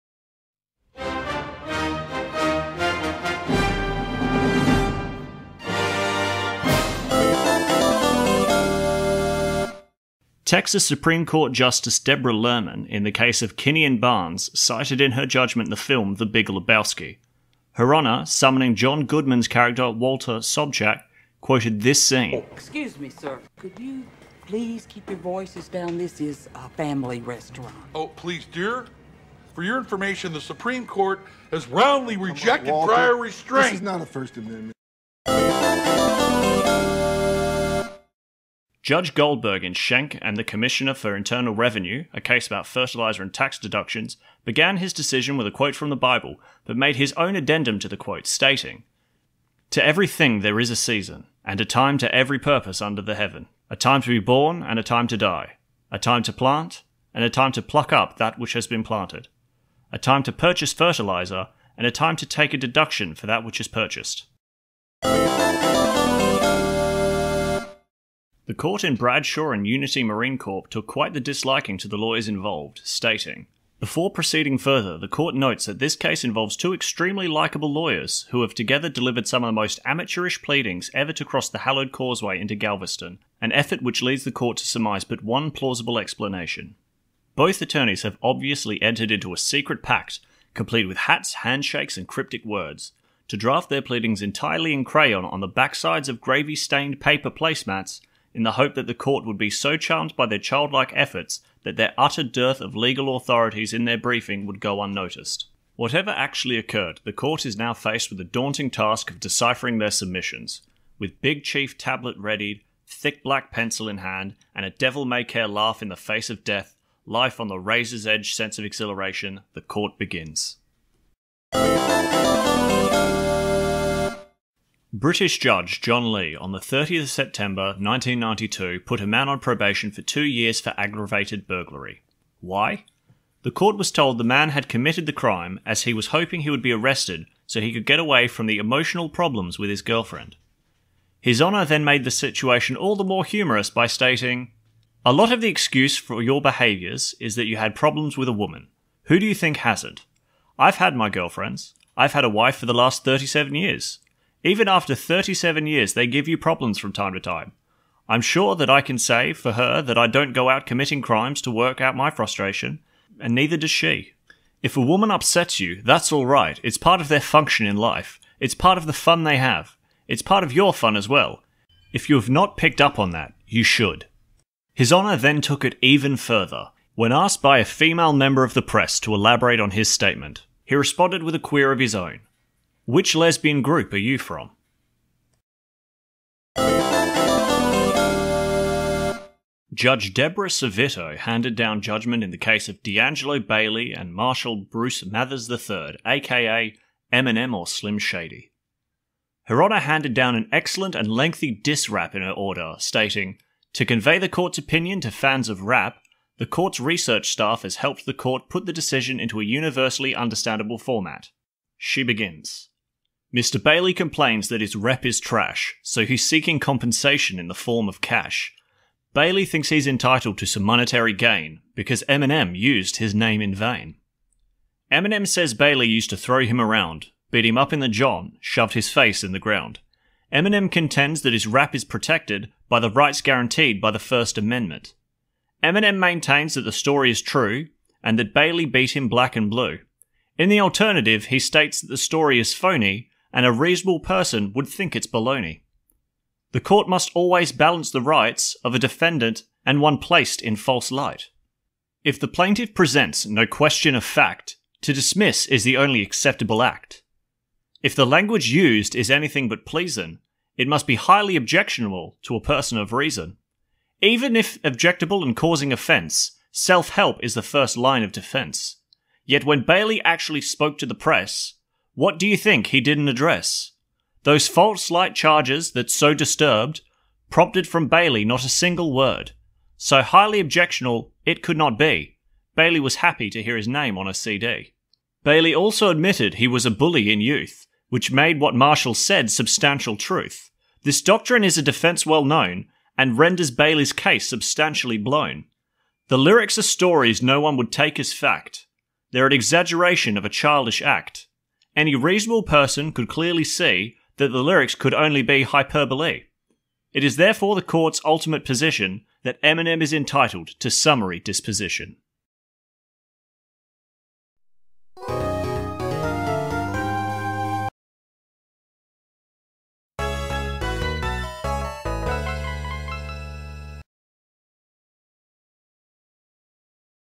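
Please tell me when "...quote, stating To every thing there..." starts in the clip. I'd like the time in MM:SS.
00:47.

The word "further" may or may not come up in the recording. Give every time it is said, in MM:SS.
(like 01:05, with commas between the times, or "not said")
01:14, 02:56.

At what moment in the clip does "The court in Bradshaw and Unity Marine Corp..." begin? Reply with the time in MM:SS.
01:08.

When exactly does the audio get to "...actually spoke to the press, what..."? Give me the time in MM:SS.
04:30.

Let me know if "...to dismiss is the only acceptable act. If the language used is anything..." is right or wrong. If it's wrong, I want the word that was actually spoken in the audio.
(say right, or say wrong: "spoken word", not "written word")
right.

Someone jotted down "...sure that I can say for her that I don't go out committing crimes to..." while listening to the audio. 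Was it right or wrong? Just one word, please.
right.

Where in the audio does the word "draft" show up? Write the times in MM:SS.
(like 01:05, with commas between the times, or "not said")
01:33.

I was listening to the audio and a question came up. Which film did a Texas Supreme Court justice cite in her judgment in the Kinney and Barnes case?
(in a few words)
The Big Lebowski.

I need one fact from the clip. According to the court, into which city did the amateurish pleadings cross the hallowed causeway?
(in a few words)
Galveston.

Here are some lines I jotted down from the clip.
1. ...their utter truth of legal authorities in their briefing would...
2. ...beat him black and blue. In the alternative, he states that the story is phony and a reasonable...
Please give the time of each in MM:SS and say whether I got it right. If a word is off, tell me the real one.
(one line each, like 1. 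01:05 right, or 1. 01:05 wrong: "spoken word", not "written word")
1. 01:41 wrong: "dearth", not "truth"
2. 03:58 right.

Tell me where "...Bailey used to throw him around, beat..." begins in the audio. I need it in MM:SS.
03:45.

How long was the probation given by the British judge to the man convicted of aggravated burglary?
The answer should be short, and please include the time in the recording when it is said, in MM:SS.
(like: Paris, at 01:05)
2 years, at 02:10.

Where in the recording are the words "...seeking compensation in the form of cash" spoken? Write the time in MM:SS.
03:36.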